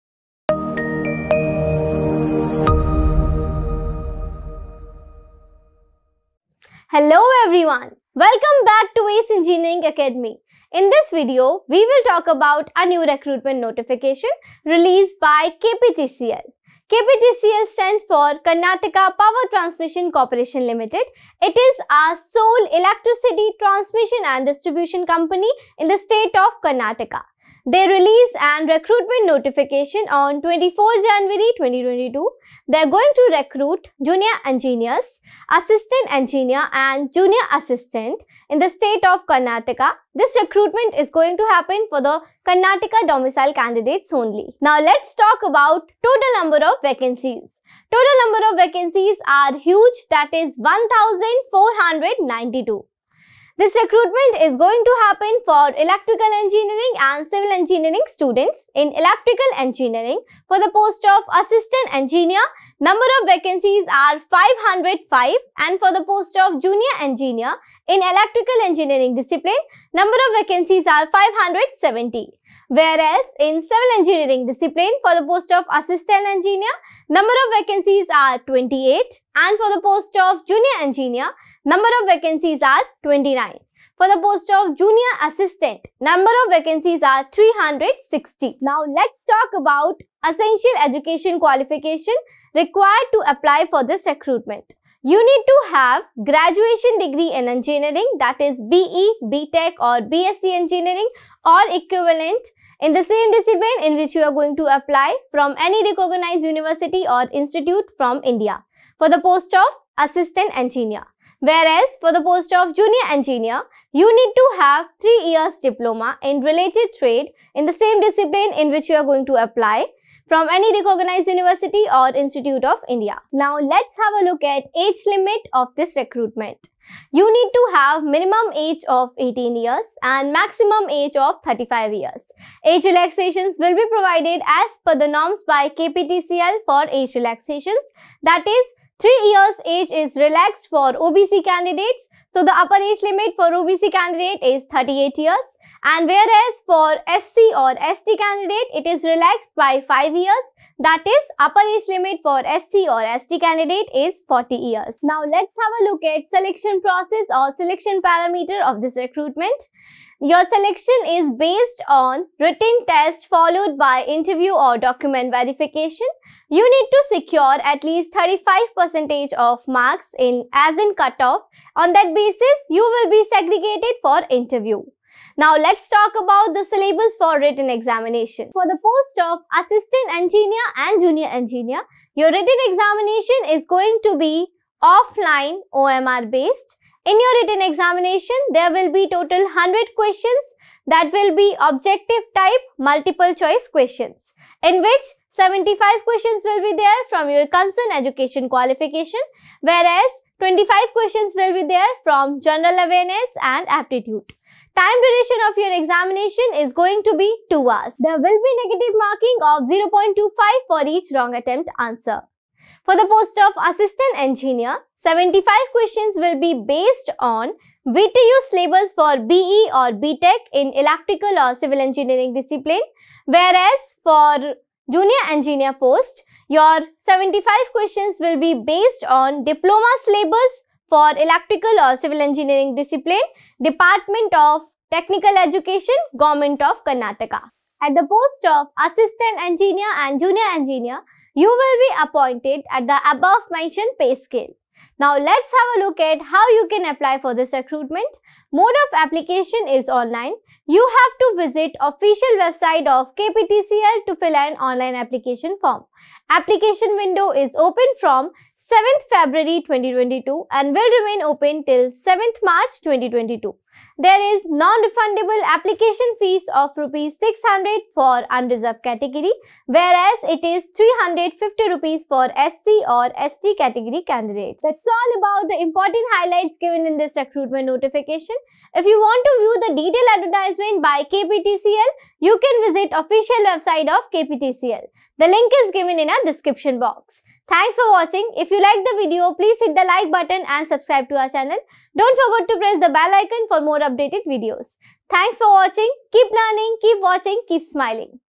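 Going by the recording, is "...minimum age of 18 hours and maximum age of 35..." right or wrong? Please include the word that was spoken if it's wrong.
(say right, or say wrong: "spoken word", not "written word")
wrong: "years", not "hours".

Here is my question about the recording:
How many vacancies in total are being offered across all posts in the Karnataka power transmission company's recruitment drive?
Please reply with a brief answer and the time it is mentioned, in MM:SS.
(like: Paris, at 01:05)
1492, at 00:50.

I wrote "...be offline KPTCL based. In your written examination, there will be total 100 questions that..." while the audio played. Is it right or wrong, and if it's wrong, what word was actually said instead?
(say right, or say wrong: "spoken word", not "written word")
wrong: "OMR", not "KPTCL".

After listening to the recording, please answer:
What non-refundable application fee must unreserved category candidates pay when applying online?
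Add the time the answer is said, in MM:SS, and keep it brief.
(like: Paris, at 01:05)
600 rupees, at 04:26.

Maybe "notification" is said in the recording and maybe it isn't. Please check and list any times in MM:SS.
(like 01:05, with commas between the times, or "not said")
00:13, 00:29, 04:37.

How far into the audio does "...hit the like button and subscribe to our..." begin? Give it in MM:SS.
04:49.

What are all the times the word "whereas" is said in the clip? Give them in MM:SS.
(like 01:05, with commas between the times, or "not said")
01:12, 01:51, 02:26, 03:19, 03:43, 04:29.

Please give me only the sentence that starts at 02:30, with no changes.
That is, upper age limit for SC or ST candidate is 40 years.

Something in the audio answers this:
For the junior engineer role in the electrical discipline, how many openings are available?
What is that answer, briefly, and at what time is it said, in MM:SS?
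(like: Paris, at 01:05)
570, at 01:11.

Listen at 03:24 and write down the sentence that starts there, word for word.
Time duration of your examination is going to be 2 hours.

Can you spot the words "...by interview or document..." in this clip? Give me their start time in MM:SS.
02:43.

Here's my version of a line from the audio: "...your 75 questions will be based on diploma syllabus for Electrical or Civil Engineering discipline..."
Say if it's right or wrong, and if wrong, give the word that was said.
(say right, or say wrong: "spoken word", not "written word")
right.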